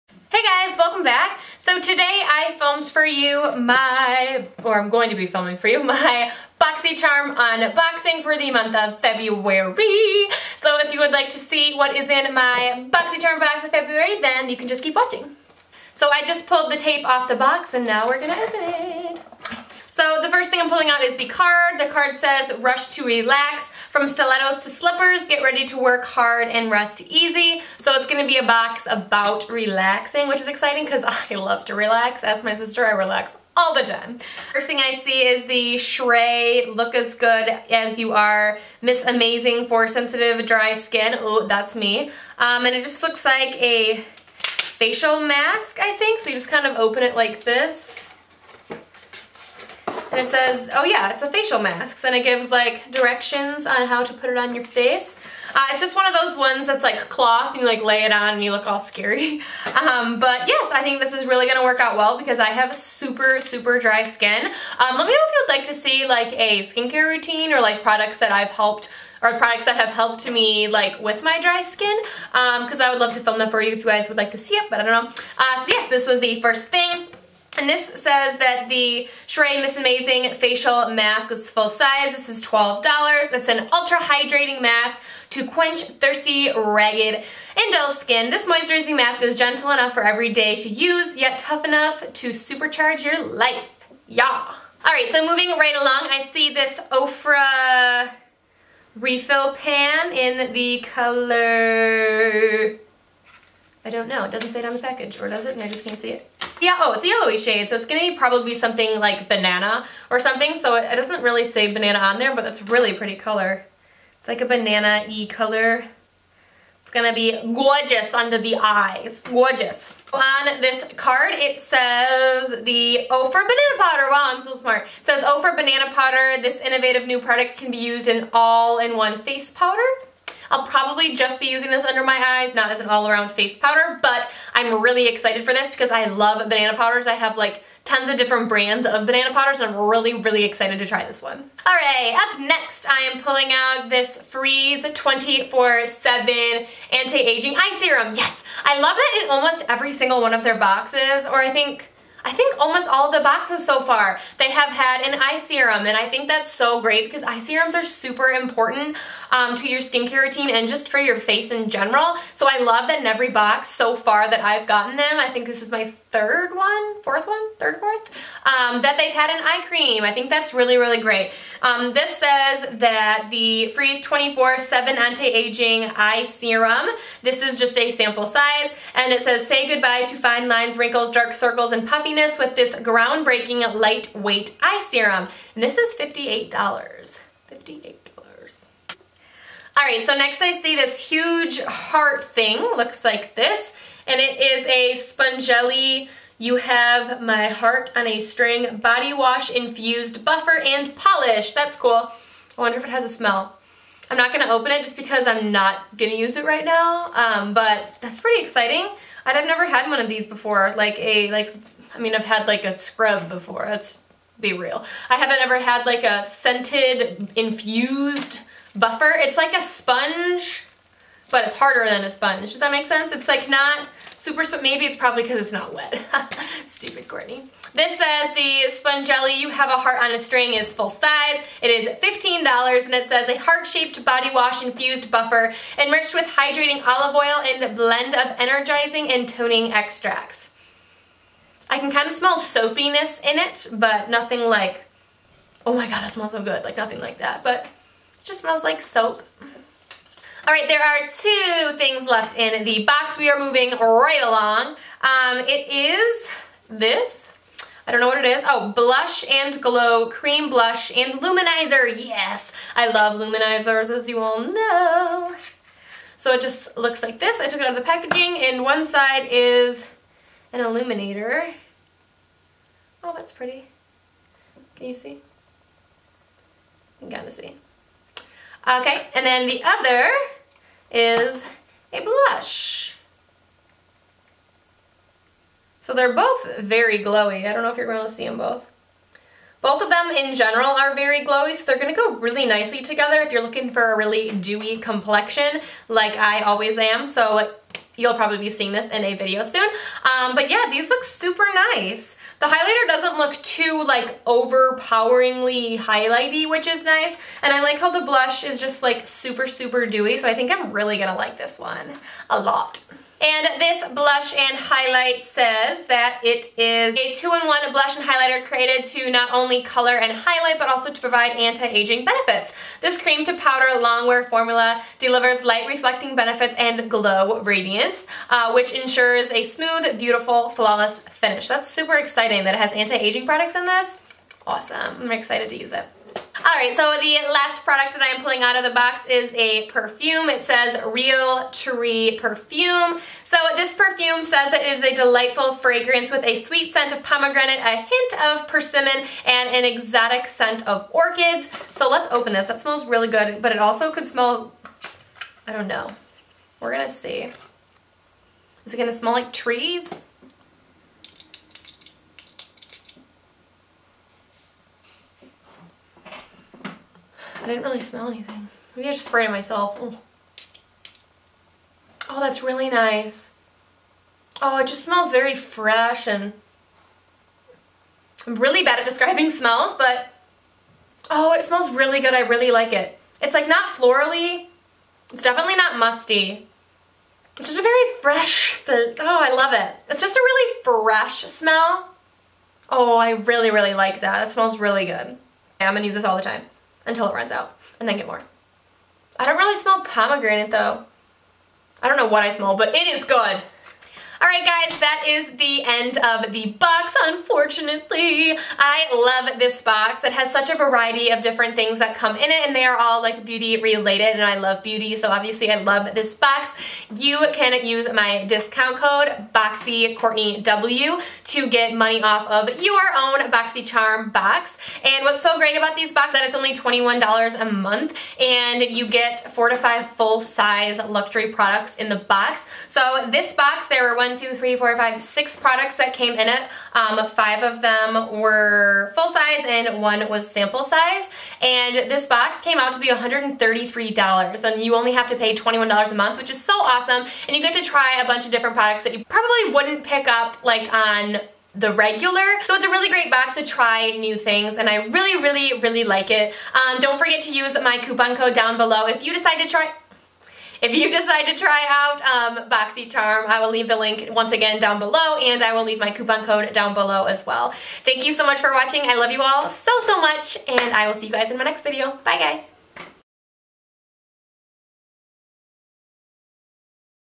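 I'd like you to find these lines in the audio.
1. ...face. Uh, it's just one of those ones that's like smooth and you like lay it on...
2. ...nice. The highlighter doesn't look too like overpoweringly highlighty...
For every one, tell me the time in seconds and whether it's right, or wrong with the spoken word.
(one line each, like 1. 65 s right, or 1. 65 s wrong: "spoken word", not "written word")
1. 54 s wrong: "cloth", not "smooth"
2. 301 s right.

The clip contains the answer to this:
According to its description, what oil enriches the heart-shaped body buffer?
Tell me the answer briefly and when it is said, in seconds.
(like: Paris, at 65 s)
olive oil, at 236 s.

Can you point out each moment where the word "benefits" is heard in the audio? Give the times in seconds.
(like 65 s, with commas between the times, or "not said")
322 s, 326 s.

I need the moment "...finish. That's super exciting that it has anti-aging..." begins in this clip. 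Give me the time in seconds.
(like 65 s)
331 s.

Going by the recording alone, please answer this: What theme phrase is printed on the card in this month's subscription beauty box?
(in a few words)
Rush to Relax.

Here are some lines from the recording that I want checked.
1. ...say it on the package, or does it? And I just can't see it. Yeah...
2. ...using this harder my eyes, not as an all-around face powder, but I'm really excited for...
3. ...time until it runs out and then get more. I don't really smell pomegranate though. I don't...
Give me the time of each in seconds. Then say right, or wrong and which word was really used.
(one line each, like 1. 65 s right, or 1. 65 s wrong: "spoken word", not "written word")
1. 104 s right
2. 131 s wrong: "under", not "harder"
3. 396 s right.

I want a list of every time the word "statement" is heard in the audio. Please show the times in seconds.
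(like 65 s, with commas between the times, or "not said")
not said.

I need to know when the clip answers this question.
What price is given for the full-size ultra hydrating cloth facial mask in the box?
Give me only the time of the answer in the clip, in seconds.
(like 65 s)
82 s.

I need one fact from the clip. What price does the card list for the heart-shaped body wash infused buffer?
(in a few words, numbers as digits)
$15.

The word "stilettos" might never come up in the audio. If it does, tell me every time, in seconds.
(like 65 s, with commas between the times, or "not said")
24 s.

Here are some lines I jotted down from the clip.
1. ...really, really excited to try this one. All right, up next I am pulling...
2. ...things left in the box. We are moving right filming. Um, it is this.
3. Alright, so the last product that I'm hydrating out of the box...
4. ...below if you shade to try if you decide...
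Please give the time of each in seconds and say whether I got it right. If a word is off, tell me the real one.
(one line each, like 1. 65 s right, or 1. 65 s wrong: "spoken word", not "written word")
1. 139 s right
2. 251 s wrong: "along", not "filming"
3. 336 s wrong: "pulling", not "hydrating"
4. 458 s wrong: "decide", not "shade".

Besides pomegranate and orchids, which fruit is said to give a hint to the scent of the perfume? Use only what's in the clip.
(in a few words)
persimmon.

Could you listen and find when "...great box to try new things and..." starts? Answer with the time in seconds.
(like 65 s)
452 s.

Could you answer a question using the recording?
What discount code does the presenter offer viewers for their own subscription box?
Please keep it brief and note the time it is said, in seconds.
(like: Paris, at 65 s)
BoxyCourtneyW, at 419 s.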